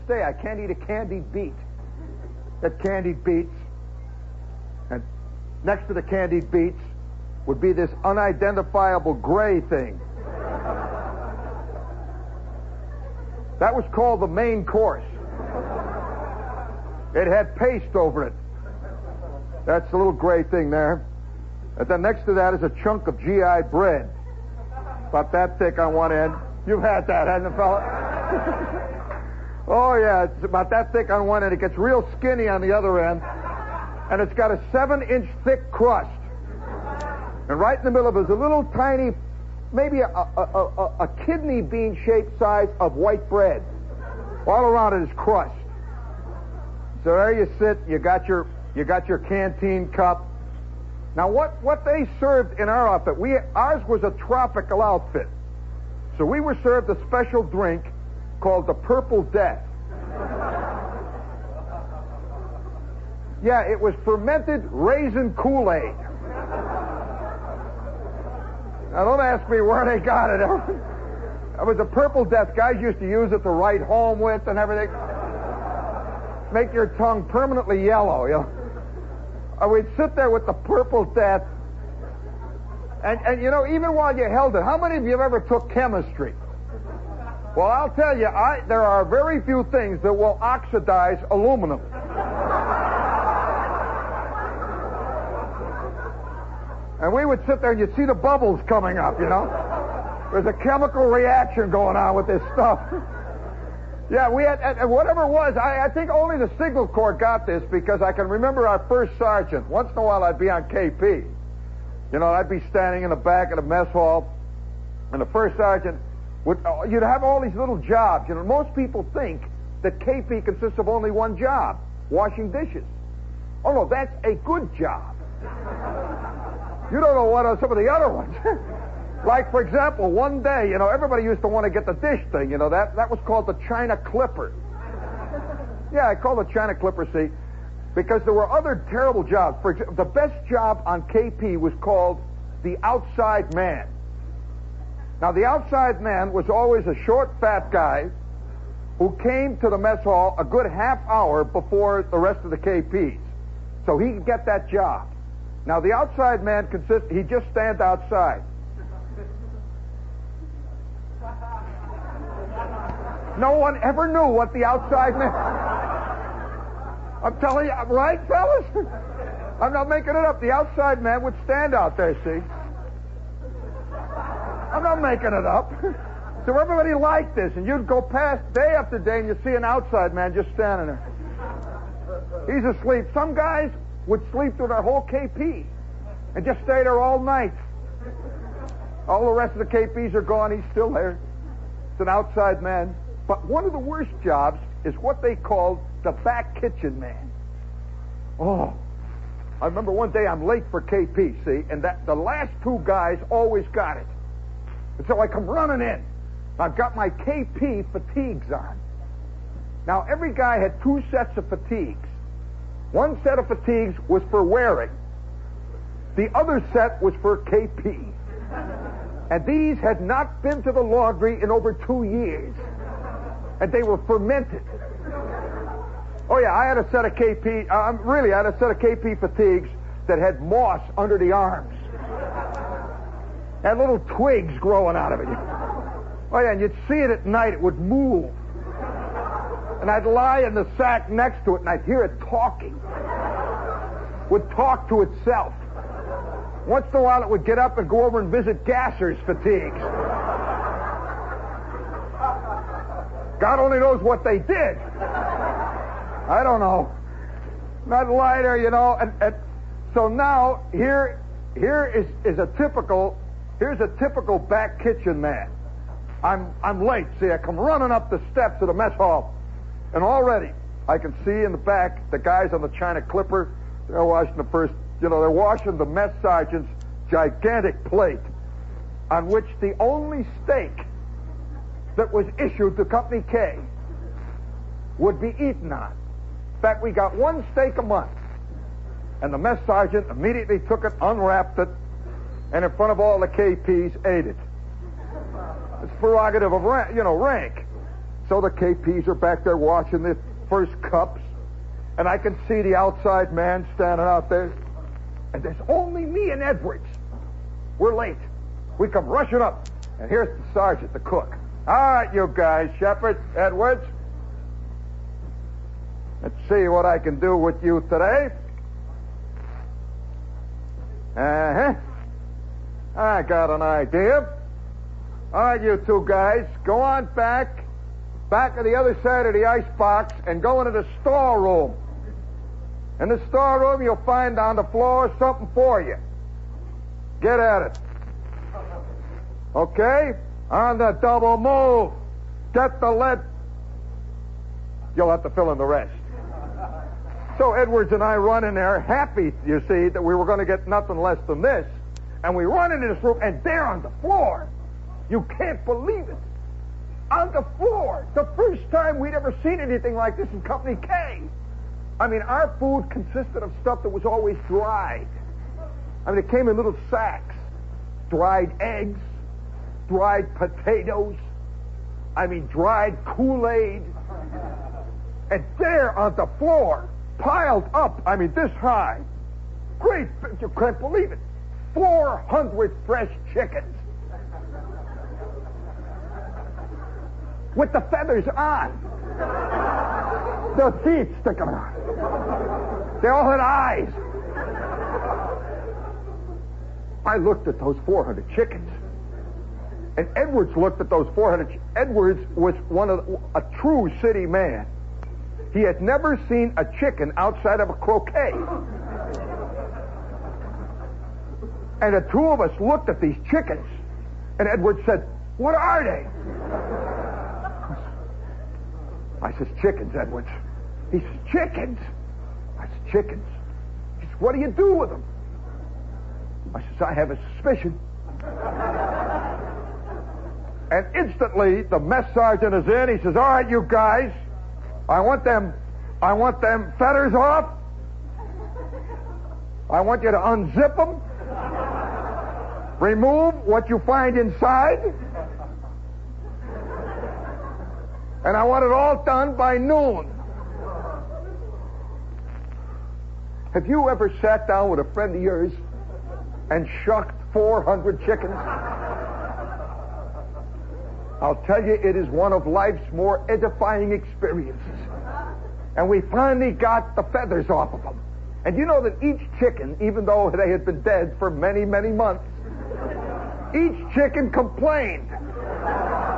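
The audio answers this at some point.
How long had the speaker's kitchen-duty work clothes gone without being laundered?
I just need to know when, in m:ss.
3:41.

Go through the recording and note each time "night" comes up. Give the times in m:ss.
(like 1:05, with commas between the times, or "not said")
3:07, 3:57.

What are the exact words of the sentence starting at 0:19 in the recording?
That's the little gray thing there.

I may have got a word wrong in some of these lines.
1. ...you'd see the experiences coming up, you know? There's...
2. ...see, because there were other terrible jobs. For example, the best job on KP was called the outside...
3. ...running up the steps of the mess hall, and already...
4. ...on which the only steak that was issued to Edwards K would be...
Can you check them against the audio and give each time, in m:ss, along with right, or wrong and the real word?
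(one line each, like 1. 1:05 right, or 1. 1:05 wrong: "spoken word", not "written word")
1. 1:37 wrong: "bubbles", not "experiences"
2. 2:17 right
3. 4:27 right
4. 4:39 wrong: "Company", not "Edwards".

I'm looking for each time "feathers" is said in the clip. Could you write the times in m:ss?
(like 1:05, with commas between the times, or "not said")
6:27, 7:47.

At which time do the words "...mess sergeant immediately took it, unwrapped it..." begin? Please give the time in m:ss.
4:49.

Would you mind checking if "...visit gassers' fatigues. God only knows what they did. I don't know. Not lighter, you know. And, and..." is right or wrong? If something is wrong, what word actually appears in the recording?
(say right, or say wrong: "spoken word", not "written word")
right.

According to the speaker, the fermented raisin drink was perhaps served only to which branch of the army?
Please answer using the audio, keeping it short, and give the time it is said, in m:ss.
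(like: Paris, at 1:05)
Signal Corps, at 1:46.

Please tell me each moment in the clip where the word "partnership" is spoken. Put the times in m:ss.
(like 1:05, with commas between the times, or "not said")
not said.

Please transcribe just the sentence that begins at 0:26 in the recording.
You've had that, hasn't it, fella?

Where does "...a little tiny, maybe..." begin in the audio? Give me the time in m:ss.
0:38.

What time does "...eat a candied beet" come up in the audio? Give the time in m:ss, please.
0:00.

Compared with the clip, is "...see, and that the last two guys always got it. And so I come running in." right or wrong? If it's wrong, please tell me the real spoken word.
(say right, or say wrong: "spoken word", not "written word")
right.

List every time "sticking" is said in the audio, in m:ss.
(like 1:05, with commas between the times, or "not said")
6:31.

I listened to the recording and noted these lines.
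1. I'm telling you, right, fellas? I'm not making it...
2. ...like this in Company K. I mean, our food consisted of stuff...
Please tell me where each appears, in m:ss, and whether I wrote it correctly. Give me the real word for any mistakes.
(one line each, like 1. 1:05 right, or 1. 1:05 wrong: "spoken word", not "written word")
1. 2:47 right
2. 5:59 right.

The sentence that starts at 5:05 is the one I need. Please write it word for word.
And there's only me and Edwards.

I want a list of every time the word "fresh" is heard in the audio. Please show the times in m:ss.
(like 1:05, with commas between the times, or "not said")
6:22.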